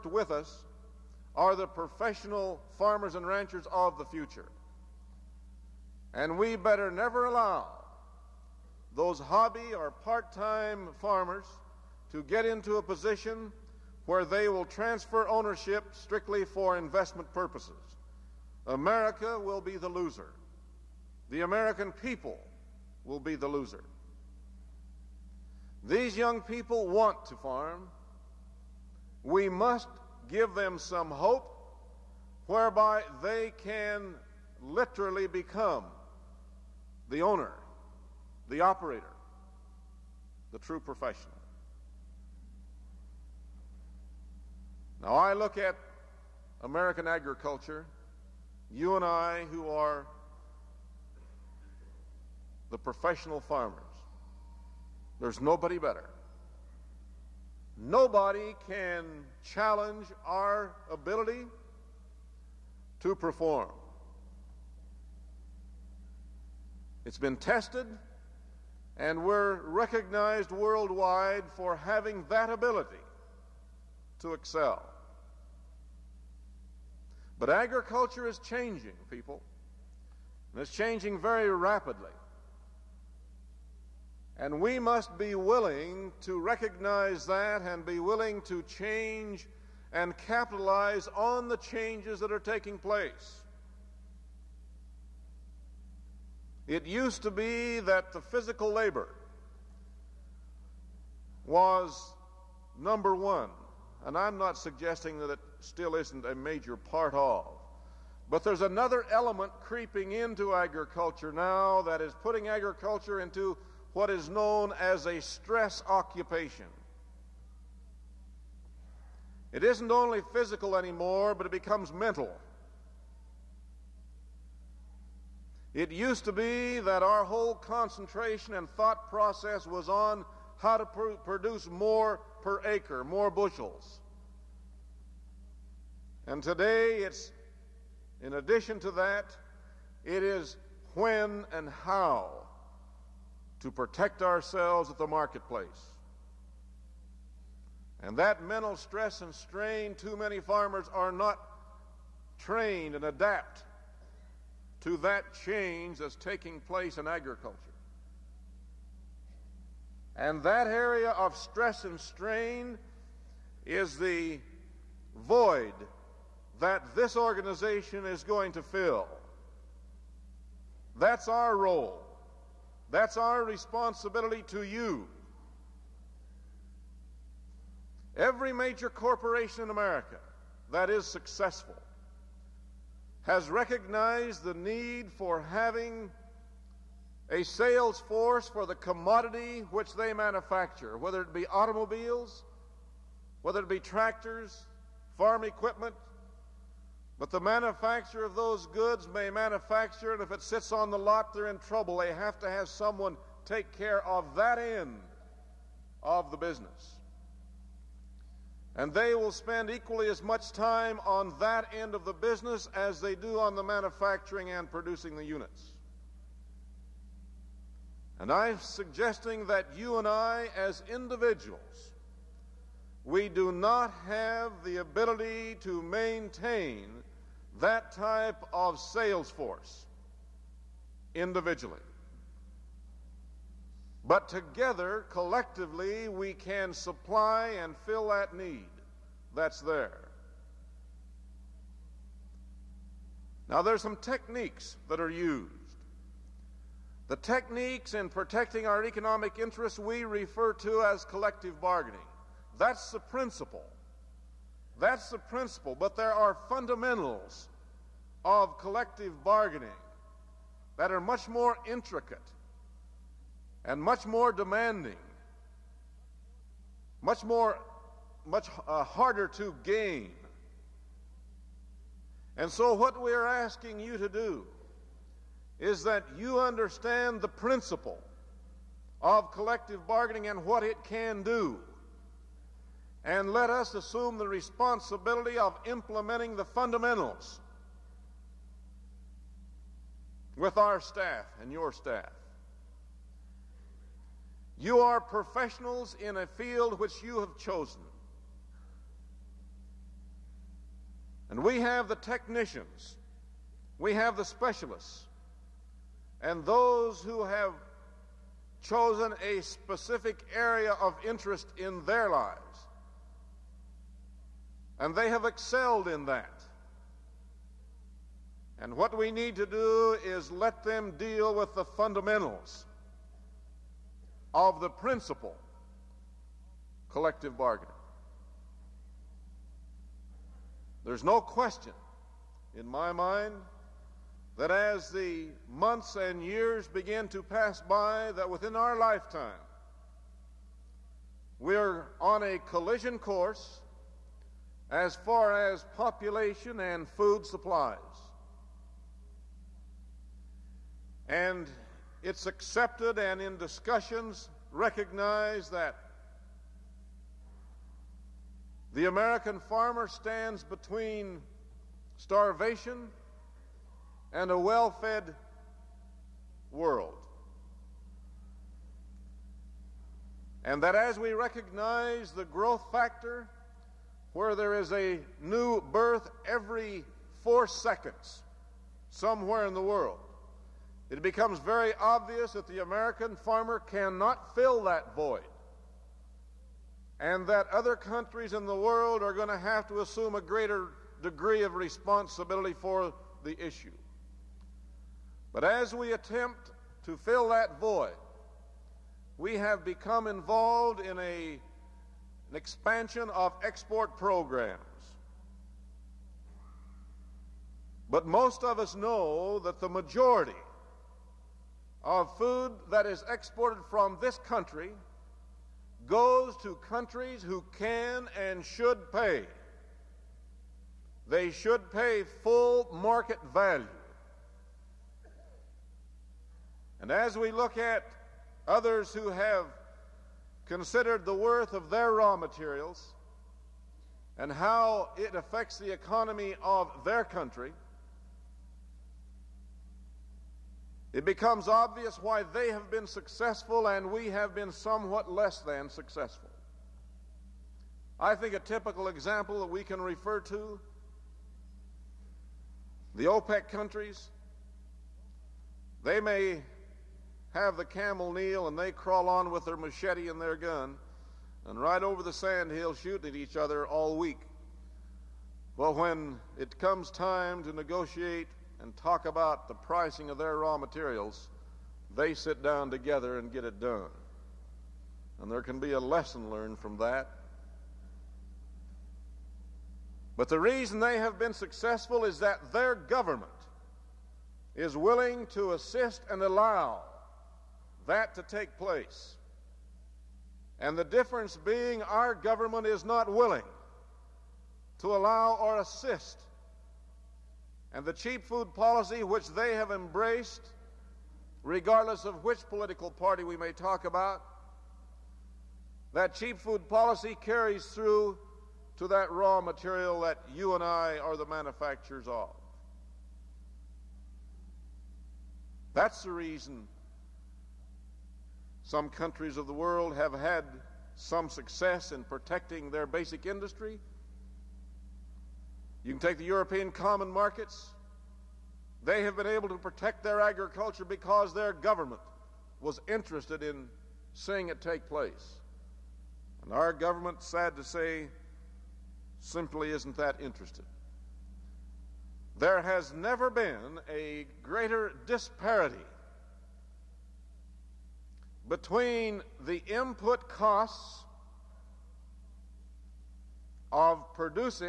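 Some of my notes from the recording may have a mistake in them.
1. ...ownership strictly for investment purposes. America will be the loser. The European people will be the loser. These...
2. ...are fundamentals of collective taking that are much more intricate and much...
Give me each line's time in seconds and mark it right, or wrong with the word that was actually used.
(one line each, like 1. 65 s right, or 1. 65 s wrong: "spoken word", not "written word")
1. 15 s wrong: "American", not "European"
2. 256 s wrong: "bargaining", not "taking".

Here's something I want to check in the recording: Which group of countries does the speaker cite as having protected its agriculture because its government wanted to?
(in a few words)
European common markets.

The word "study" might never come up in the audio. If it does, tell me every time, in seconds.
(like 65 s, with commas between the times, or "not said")
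not said.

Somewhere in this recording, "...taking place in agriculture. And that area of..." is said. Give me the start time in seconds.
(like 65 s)
156 s.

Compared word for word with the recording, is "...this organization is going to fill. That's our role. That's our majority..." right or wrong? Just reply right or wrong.
wrong.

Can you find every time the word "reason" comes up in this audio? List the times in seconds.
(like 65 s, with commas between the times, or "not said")
480 s, 516 s.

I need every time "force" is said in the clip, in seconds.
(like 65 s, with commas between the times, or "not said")
188 s, 229 s.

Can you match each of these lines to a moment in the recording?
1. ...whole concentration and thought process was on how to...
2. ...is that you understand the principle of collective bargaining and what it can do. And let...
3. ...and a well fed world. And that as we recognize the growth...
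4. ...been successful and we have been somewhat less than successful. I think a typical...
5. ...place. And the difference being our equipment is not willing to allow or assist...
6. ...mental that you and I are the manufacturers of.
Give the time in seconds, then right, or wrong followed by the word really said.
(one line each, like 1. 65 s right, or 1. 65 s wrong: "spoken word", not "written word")
1. 127 s right
2. 275 s right
3. 364 s right
4. 442 s right
5. 488 s wrong: "government", not "equipment"
6. 509 s wrong: "material", not "mental".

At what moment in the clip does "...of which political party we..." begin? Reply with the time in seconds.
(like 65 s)
502 s.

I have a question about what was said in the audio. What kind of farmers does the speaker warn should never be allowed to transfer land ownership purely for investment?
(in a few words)
hobby or part-time farmers.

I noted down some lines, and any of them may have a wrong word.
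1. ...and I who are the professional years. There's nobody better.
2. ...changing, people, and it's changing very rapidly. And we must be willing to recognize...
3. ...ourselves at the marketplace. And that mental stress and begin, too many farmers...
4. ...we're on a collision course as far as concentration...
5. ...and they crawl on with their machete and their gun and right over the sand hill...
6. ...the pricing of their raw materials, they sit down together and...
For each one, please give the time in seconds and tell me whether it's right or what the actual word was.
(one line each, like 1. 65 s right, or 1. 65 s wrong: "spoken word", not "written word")
1. 48 s wrong: "farmers", not "years"
2. 78 s right
3. 144 s wrong: "strain", not "begin"
4. 341 s wrong: "population", not "concentration"
5. 458 s right
6. 469 s right.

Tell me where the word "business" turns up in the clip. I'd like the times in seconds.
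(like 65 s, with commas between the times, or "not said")
206 s, 212 s.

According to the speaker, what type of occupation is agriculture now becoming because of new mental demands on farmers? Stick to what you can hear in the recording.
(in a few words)
stress occupation.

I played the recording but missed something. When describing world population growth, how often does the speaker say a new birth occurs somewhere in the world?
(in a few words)
every 4 seconds.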